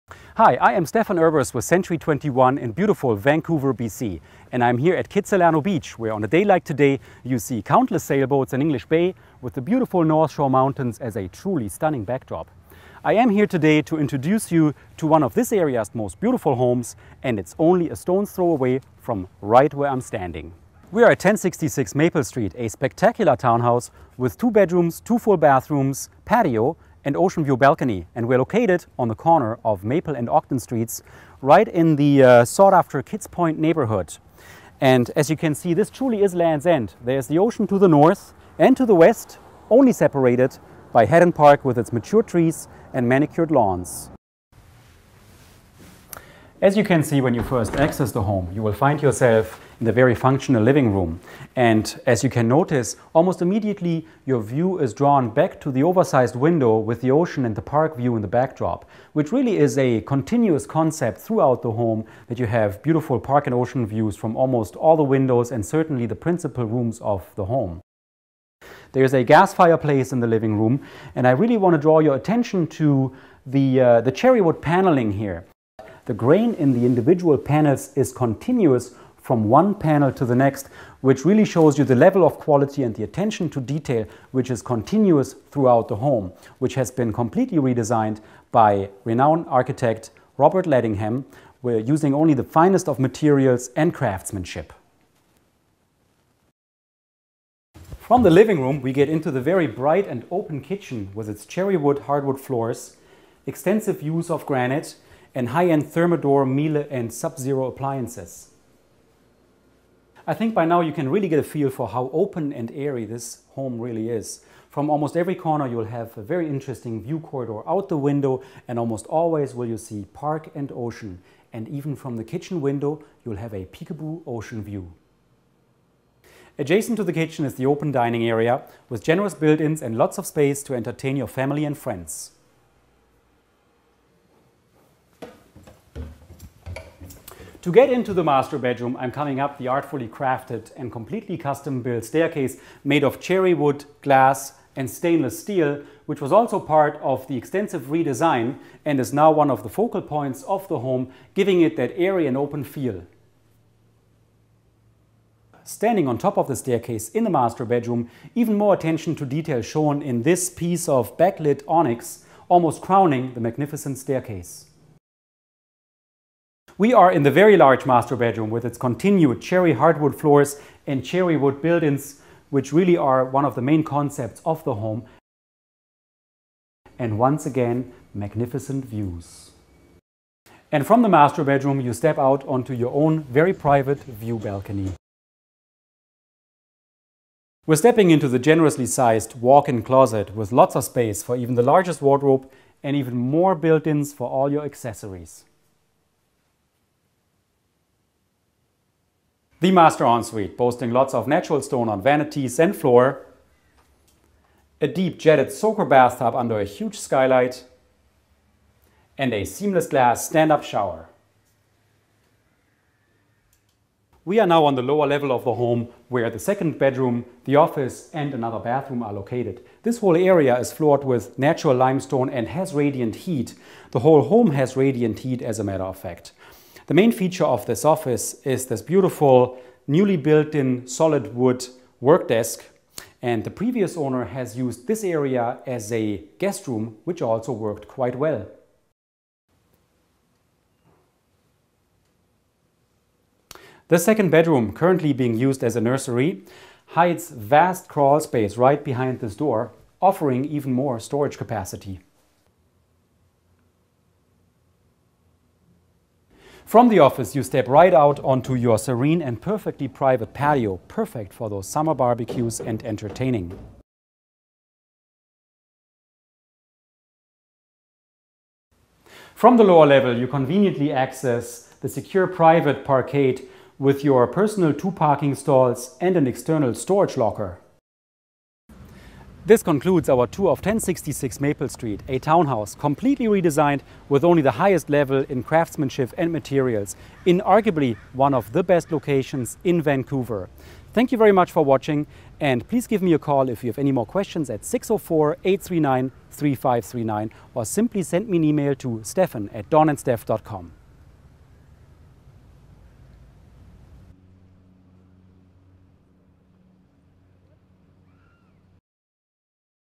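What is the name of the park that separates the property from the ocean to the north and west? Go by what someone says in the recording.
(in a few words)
Hadden Park.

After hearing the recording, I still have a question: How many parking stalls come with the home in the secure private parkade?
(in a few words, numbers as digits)
2.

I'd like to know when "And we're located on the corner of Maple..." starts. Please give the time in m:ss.
0:28.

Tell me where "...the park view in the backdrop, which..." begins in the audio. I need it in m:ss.
0:57.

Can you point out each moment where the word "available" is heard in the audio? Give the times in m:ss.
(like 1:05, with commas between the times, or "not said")
not said.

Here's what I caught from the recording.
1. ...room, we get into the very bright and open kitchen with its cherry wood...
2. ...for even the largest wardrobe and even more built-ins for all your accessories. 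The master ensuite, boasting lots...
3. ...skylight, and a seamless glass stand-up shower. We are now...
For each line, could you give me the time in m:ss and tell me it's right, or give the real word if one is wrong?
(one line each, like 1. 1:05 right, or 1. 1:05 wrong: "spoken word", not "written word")
1. 1:38 right
2. 3:11 right
3. 3:26 right.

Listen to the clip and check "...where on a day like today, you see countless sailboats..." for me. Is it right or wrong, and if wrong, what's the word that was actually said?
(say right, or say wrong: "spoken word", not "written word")
right.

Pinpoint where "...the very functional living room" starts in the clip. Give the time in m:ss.
0:49.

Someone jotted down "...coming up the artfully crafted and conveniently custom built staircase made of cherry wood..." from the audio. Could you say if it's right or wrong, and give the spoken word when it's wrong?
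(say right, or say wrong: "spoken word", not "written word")
wrong: "completely", not "conveniently".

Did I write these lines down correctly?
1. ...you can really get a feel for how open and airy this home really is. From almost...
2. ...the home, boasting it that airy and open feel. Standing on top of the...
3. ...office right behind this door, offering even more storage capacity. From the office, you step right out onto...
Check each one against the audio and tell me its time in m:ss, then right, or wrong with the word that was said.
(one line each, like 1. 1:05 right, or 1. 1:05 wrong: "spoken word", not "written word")
1. 1:50 right
2. 2:30 wrong: "giving", not "boasting"
3. 4:08 wrong: "space", not "office".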